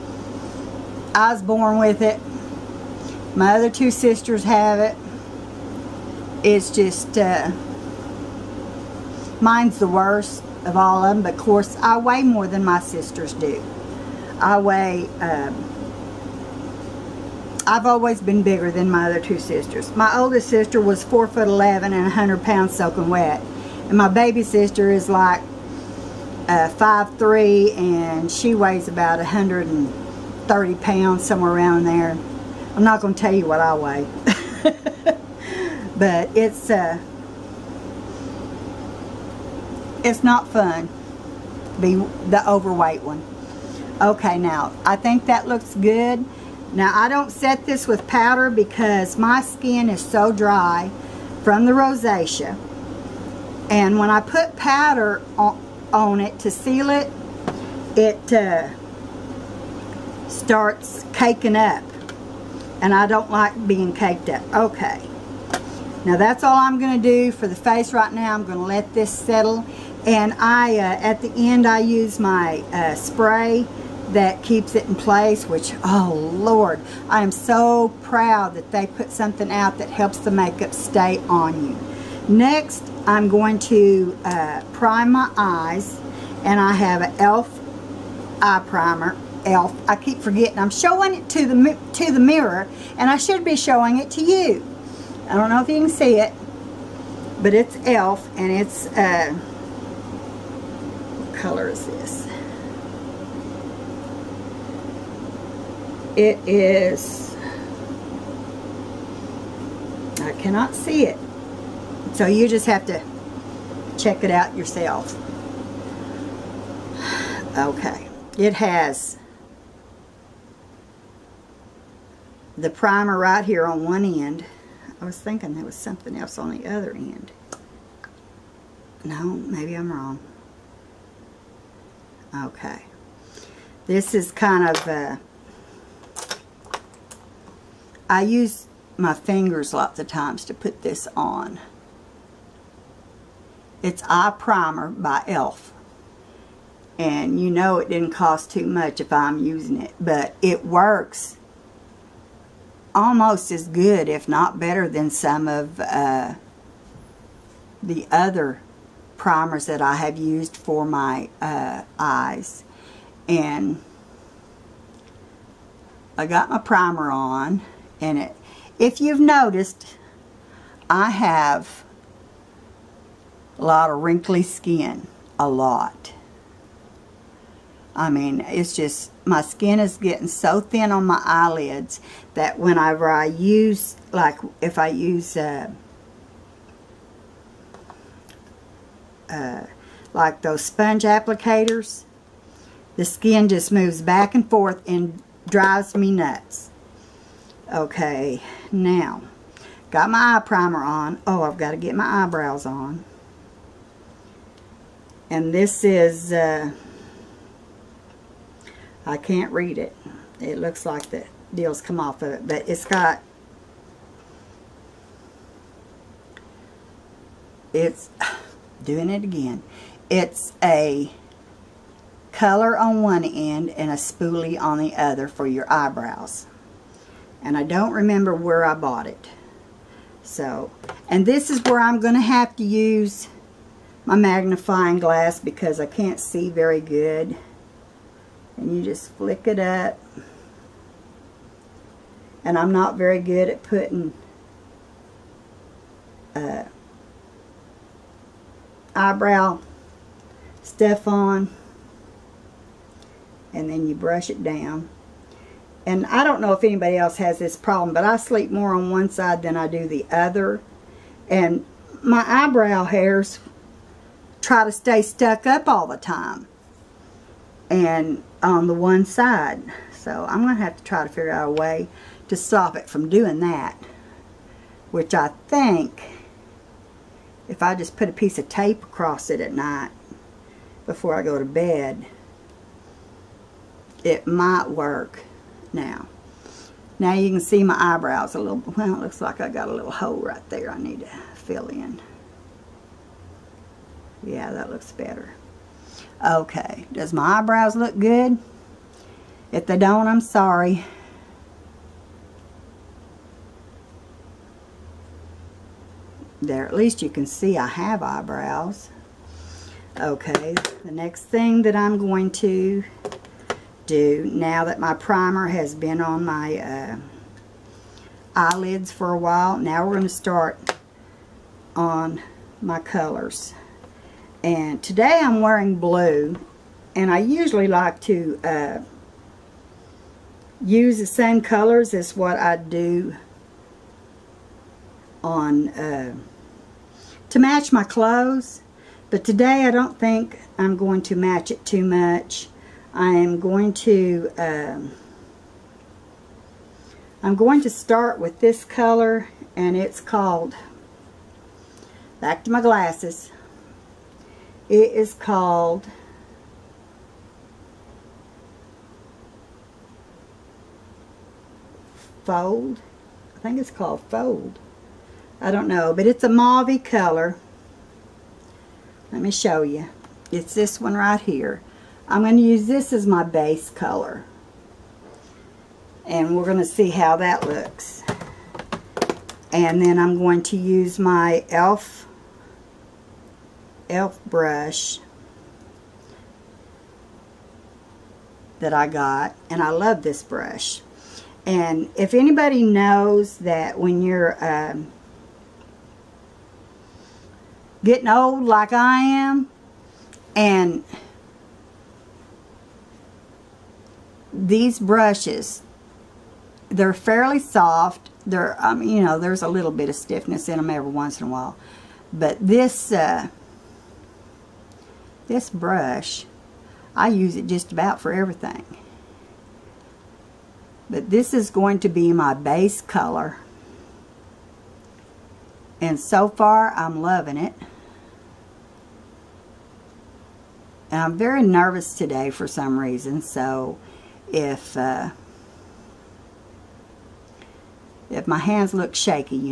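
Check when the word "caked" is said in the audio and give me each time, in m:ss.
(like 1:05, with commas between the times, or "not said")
1:03.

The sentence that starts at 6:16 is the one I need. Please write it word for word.
And we're going to see how that looks.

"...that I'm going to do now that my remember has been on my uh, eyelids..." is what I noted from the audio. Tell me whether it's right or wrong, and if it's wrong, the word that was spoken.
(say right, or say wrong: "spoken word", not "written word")
wrong: "primer", not "remember".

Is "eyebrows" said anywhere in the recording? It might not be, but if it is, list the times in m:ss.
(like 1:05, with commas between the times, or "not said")
3:22, 3:45, 4:08, 4:22, 4:47, 4:57, 5:08.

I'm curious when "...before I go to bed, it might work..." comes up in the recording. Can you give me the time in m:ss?
4:40.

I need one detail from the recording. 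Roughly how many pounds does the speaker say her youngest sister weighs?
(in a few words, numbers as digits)
130 pounds.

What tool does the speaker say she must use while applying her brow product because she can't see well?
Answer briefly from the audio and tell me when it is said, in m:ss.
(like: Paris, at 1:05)
magnifying glass, at 3:54.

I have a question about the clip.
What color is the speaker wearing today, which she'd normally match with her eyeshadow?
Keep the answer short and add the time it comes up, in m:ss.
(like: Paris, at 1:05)
blue, at 5:25.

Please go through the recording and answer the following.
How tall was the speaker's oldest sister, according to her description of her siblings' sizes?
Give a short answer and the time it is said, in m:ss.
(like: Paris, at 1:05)
4 foot 11, at 0:21.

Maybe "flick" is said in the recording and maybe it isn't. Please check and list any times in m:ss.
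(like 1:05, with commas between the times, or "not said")
3:59.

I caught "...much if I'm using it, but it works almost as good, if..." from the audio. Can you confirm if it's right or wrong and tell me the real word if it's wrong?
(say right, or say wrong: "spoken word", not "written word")
right.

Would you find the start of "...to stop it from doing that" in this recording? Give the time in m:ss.
4:32.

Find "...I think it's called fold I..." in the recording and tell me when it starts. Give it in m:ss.
6:03.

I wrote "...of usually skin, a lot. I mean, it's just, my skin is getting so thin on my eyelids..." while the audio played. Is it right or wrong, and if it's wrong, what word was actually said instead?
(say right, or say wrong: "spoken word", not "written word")
wrong: "wrinkly", not "usually".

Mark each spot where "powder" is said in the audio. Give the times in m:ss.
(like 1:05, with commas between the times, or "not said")
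0:48, 0:54.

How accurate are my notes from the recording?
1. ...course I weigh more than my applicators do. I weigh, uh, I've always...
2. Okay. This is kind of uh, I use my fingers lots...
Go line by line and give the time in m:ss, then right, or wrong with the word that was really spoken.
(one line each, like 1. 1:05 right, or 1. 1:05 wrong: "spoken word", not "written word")
1. 0:11 wrong: "sisters", not "applicators"
2. 2:12 right.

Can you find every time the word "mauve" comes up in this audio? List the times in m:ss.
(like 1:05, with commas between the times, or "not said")
6:06.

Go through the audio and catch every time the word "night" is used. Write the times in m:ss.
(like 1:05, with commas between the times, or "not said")
4:39.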